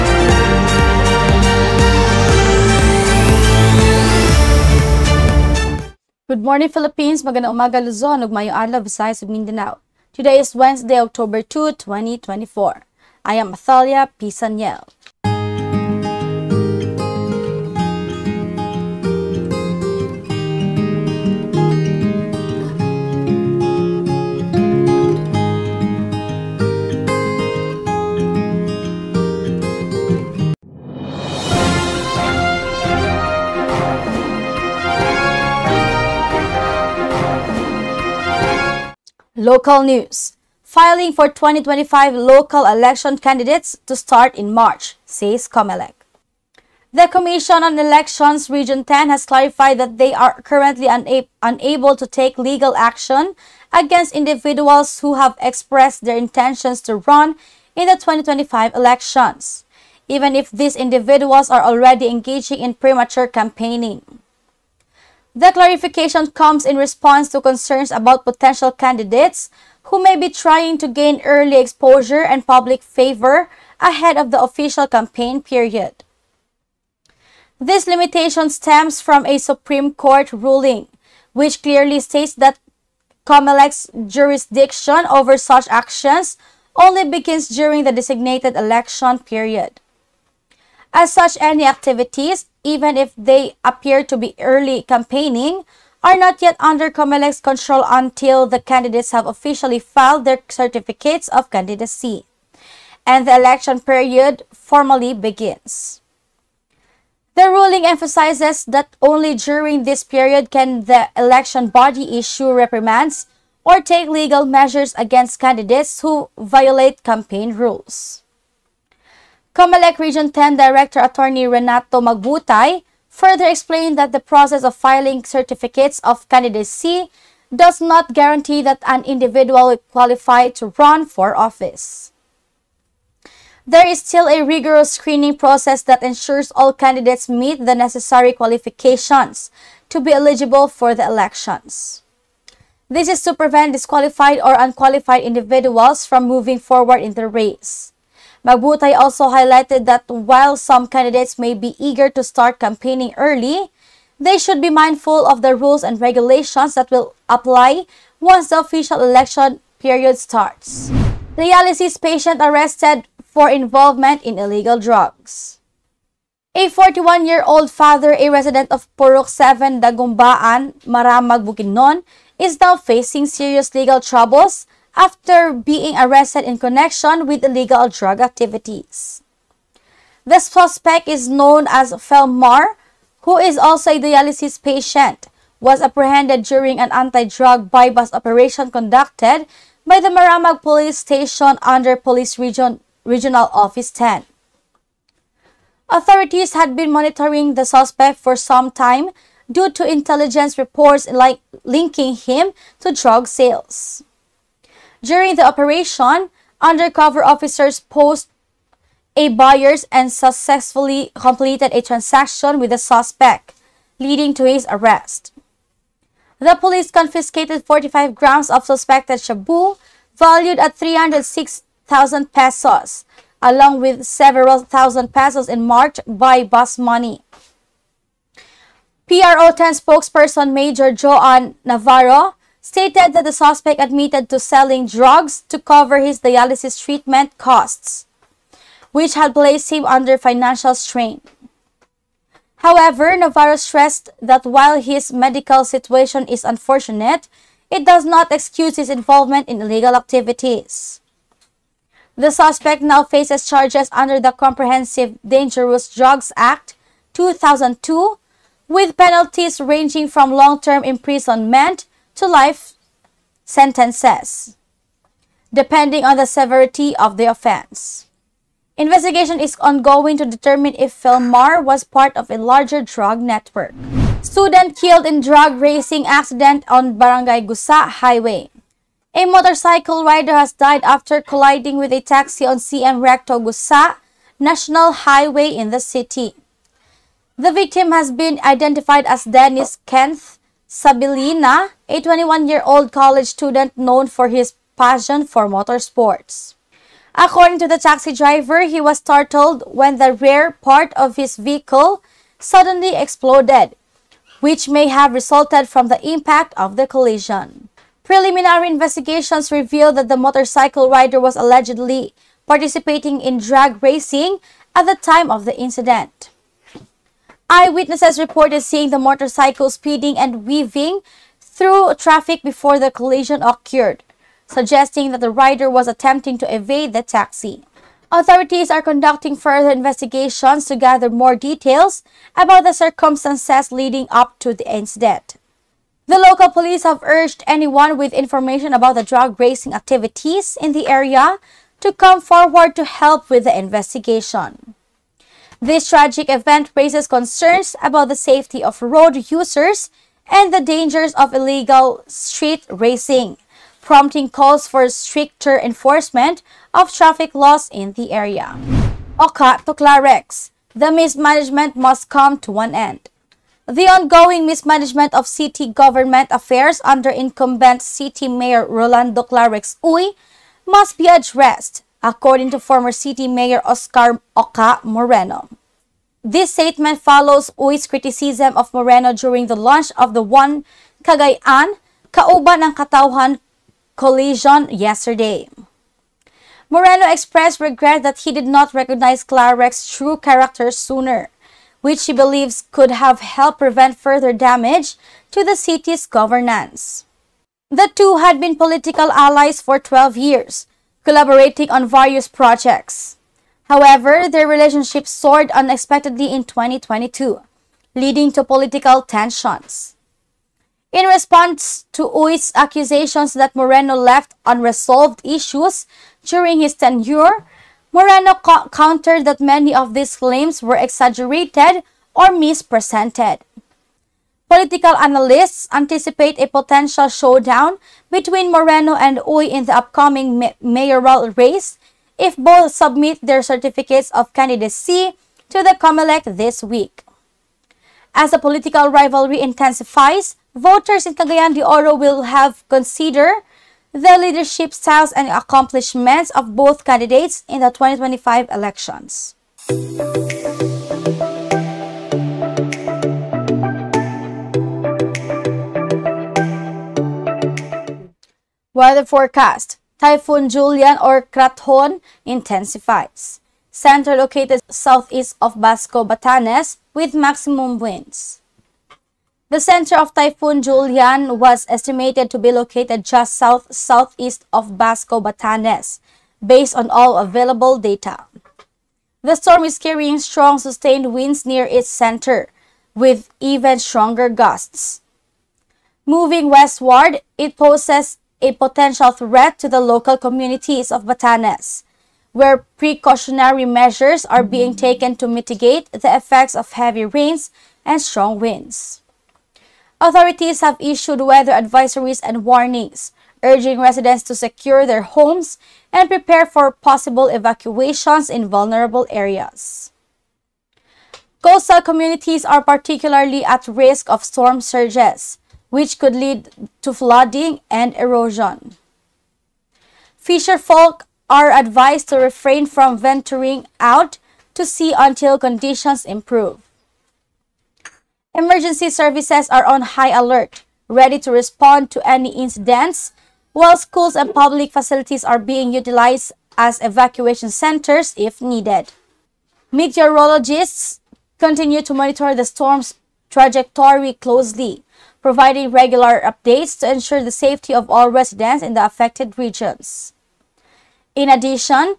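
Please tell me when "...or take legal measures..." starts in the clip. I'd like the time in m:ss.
1:53.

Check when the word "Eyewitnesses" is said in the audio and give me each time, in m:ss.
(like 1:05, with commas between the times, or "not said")
5:17.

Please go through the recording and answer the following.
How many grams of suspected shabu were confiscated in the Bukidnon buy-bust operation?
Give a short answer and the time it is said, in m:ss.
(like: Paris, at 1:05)
45, at 3:37.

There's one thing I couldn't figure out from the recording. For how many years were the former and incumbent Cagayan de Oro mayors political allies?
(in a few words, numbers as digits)
12.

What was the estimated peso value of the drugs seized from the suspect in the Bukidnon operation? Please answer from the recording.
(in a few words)
306,000 pesos.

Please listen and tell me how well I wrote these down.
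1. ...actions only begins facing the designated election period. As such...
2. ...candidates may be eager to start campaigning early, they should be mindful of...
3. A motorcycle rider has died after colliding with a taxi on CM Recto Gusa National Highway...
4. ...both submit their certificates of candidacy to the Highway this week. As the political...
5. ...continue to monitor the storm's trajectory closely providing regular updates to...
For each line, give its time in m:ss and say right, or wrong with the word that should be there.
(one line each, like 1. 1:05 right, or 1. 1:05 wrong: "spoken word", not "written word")
1. 1:25 wrong: "during", not "facing"
2. 2:30 right
3. 4:39 right
4. 7:12 wrong: "COMELEC", not "Highway"
5. 9:01 right.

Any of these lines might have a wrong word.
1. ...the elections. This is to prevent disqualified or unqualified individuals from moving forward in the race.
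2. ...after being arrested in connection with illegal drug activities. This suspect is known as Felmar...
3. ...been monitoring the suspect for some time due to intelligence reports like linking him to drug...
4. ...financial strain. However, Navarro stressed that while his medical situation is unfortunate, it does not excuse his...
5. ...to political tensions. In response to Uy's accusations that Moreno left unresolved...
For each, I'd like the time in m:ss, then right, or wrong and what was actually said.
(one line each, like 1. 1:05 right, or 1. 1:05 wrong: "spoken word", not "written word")
1. 2:20 right
2. 2:54 right
3. 3:16 right
4. 4:00 right
5. 6:48 right.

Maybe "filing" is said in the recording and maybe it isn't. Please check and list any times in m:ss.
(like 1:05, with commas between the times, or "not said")
0:40, 2:04.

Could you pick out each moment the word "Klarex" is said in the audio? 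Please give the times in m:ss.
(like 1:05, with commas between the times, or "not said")
5:59, 6:09, 6:29.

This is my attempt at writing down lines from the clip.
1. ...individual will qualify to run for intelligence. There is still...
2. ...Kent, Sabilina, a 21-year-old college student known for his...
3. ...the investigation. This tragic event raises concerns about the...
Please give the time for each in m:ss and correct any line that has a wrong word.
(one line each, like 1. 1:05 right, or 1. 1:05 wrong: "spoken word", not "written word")
1. 2:09 wrong: "office", not "intelligence"
2. 4:49 right
3. 5:43 right.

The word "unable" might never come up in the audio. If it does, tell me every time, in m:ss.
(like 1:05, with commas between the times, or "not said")
0:51.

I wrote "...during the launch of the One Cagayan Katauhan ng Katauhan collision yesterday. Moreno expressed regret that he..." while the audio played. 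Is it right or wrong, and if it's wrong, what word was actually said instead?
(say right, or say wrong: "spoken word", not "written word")
wrong: "Kauban", not "Katauhan".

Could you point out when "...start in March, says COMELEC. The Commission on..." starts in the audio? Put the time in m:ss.
0:43.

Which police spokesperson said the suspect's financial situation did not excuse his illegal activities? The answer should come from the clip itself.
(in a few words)
Joan Navarro.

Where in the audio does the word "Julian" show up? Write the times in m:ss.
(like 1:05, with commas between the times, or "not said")
7:40, 7:50.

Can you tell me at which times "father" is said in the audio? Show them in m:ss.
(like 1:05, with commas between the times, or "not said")
2:47.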